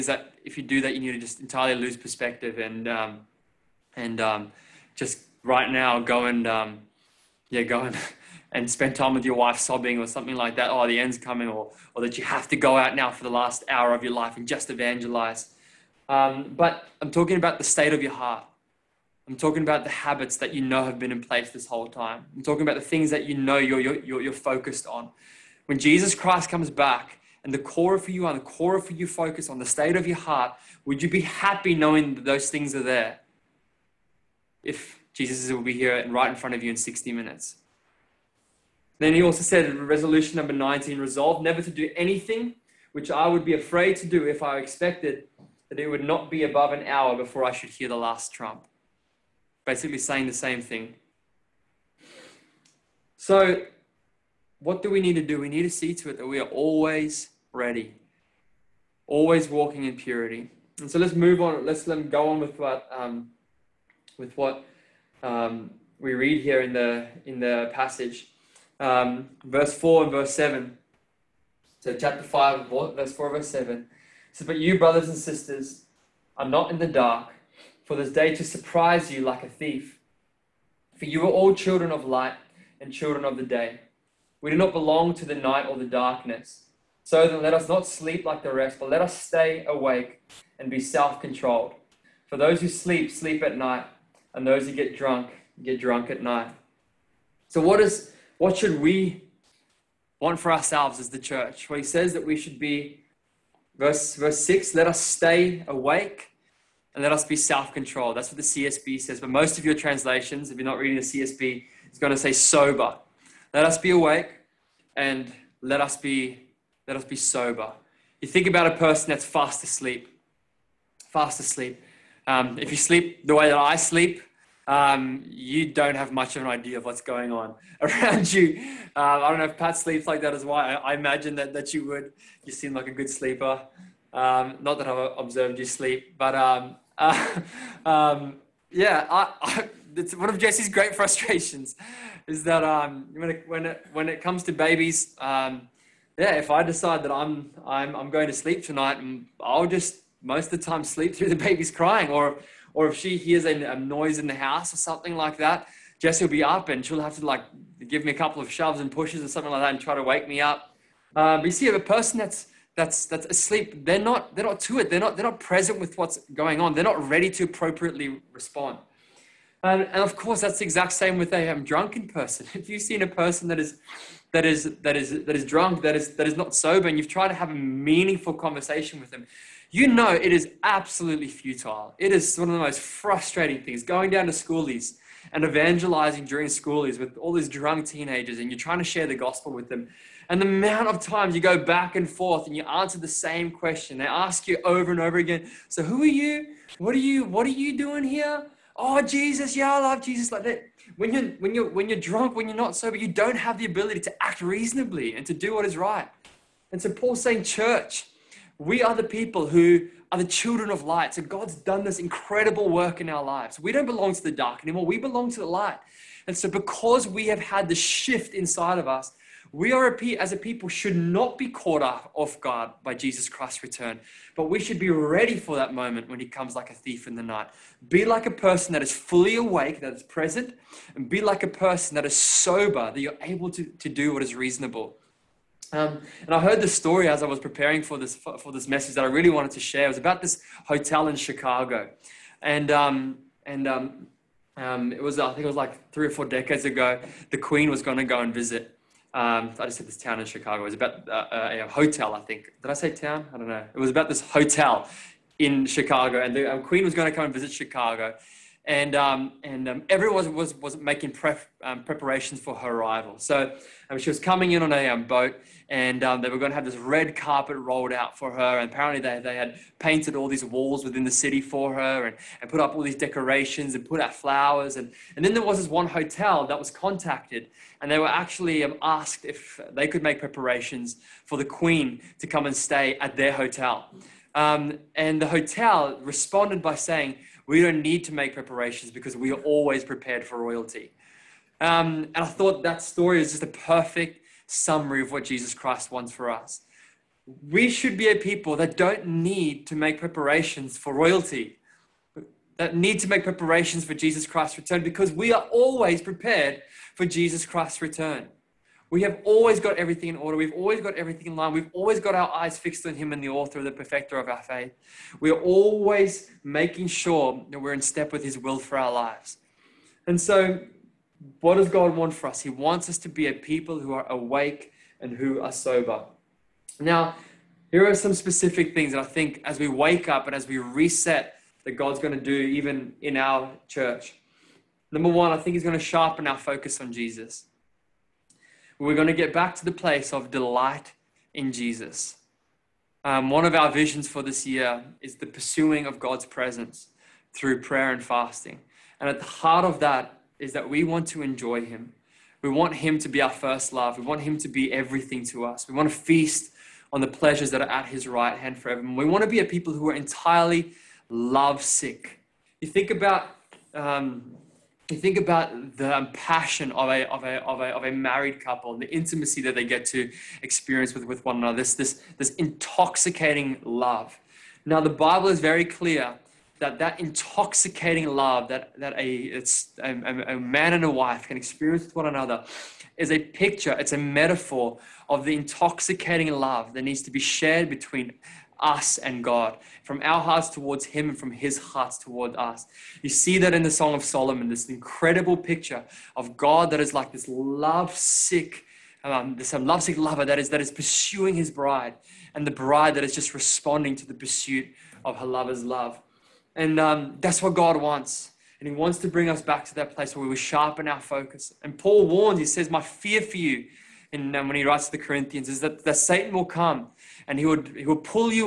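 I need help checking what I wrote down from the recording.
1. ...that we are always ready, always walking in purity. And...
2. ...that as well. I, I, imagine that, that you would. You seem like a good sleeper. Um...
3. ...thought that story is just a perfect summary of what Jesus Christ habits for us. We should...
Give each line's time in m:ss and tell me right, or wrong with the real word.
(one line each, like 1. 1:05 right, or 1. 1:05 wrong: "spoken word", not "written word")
1. 0:56 right
2. 2:10 right
3. 4:52 wrong: "wants", not "habits".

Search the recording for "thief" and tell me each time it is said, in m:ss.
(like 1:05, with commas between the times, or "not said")
1:19, 3:46.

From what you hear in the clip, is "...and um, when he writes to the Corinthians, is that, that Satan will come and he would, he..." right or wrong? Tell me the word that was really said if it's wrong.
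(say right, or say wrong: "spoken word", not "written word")
right.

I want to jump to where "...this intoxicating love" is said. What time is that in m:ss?
6:12.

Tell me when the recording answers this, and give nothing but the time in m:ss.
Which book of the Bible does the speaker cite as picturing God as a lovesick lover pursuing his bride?
6:33.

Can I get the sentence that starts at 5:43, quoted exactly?
Um, one of our visions for this year is the pursuing of God's presence through prayer and fasting.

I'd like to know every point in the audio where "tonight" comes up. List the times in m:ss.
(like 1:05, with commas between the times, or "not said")
2:28.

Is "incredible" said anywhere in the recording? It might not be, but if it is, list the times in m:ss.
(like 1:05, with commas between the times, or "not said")
3:31, 6:34.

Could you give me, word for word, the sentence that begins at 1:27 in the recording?
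So then let us not sleep like the rest, but let us stay awake and be self controlled.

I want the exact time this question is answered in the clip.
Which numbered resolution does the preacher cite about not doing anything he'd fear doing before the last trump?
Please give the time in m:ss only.
0:40.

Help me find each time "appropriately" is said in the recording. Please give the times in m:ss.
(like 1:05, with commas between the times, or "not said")
2:47.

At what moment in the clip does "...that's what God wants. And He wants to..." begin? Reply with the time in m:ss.
6:47.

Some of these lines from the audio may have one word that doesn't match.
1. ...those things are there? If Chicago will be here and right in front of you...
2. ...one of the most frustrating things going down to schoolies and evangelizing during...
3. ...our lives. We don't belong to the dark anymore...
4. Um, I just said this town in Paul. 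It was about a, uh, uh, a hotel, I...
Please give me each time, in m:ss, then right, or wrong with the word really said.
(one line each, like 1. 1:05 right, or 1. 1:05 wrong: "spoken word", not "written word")
1. 0:32 wrong: "Jesus", not "Chicago"
2. 3:02 right
3. 3:33 right
4. 4:09 wrong: "Chicago", not "Paul".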